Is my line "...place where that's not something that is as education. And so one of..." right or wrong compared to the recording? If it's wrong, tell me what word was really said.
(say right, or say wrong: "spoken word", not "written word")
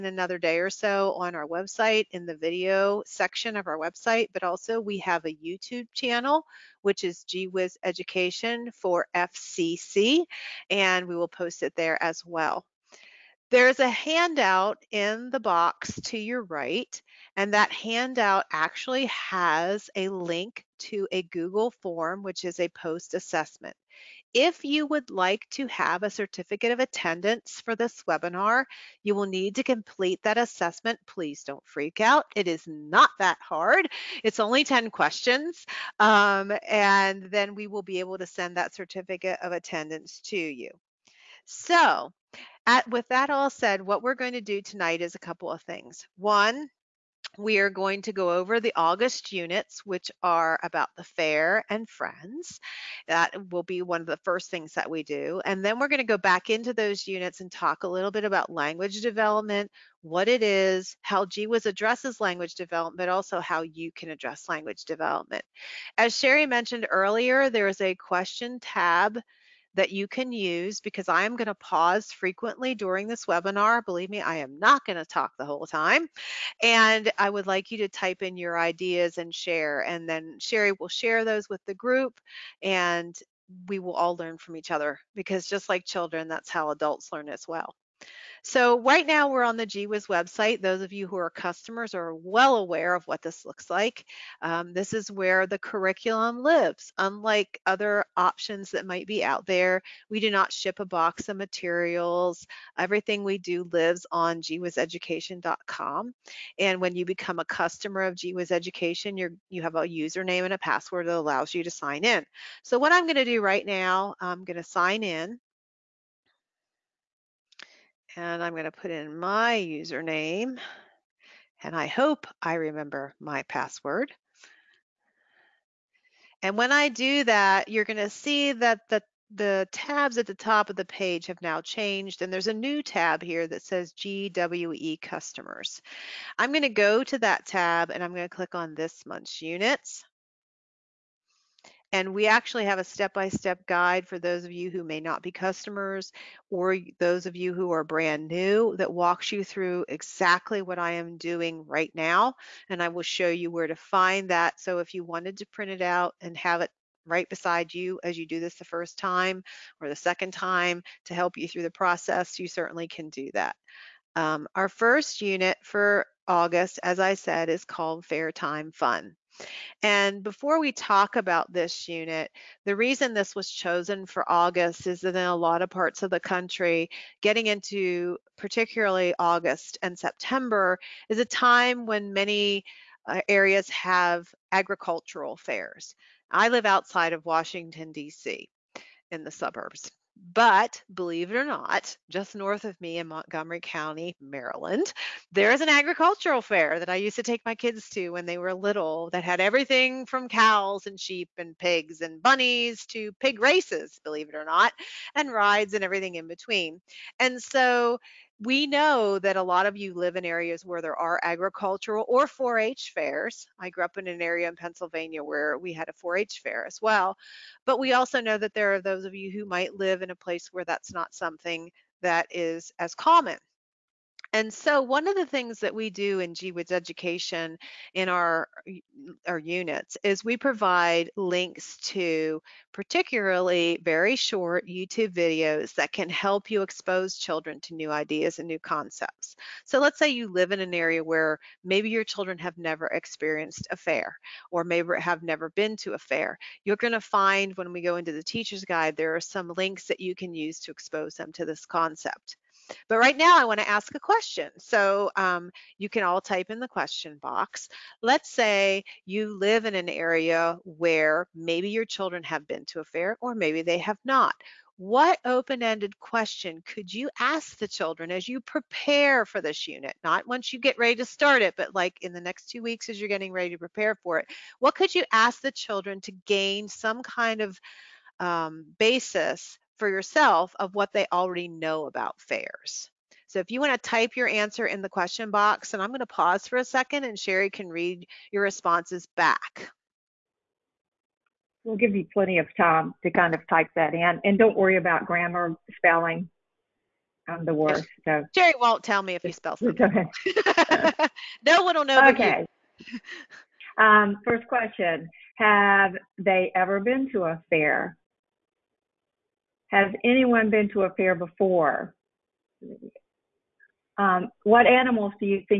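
wrong: "common", not "education".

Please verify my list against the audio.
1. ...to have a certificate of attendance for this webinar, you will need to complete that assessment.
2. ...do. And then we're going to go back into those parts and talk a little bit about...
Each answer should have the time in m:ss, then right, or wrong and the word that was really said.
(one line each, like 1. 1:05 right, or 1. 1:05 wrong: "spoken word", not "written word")
1. 0:25 right
2. 0:55 wrong: "units", not "parts".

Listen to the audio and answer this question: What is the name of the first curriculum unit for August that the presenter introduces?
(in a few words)
Fair Time Fun.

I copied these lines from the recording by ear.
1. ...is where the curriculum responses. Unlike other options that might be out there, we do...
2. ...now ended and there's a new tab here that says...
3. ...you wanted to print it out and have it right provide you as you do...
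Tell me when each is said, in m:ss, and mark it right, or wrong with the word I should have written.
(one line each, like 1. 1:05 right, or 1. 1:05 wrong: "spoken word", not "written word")
1. 1:34 wrong: "lives", not "responses"
2. 2:11 wrong: "changed", not "ended"
3. 2:34 wrong: "beside", not "provide".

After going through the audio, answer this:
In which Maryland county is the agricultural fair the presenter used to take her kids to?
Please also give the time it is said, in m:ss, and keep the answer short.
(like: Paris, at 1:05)
Montgomery County, at 3:13.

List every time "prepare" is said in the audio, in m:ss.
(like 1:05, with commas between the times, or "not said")
4:28, 4:33.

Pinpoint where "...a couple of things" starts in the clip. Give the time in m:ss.
0:45.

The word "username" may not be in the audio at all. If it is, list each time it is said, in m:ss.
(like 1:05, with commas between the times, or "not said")
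1:49, 1:59.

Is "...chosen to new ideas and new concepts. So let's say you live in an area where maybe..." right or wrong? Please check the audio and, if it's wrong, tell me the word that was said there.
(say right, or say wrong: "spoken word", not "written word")
wrong: "children", not "chosen".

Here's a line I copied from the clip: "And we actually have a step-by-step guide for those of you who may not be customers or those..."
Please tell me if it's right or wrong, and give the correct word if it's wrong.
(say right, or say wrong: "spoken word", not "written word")
right.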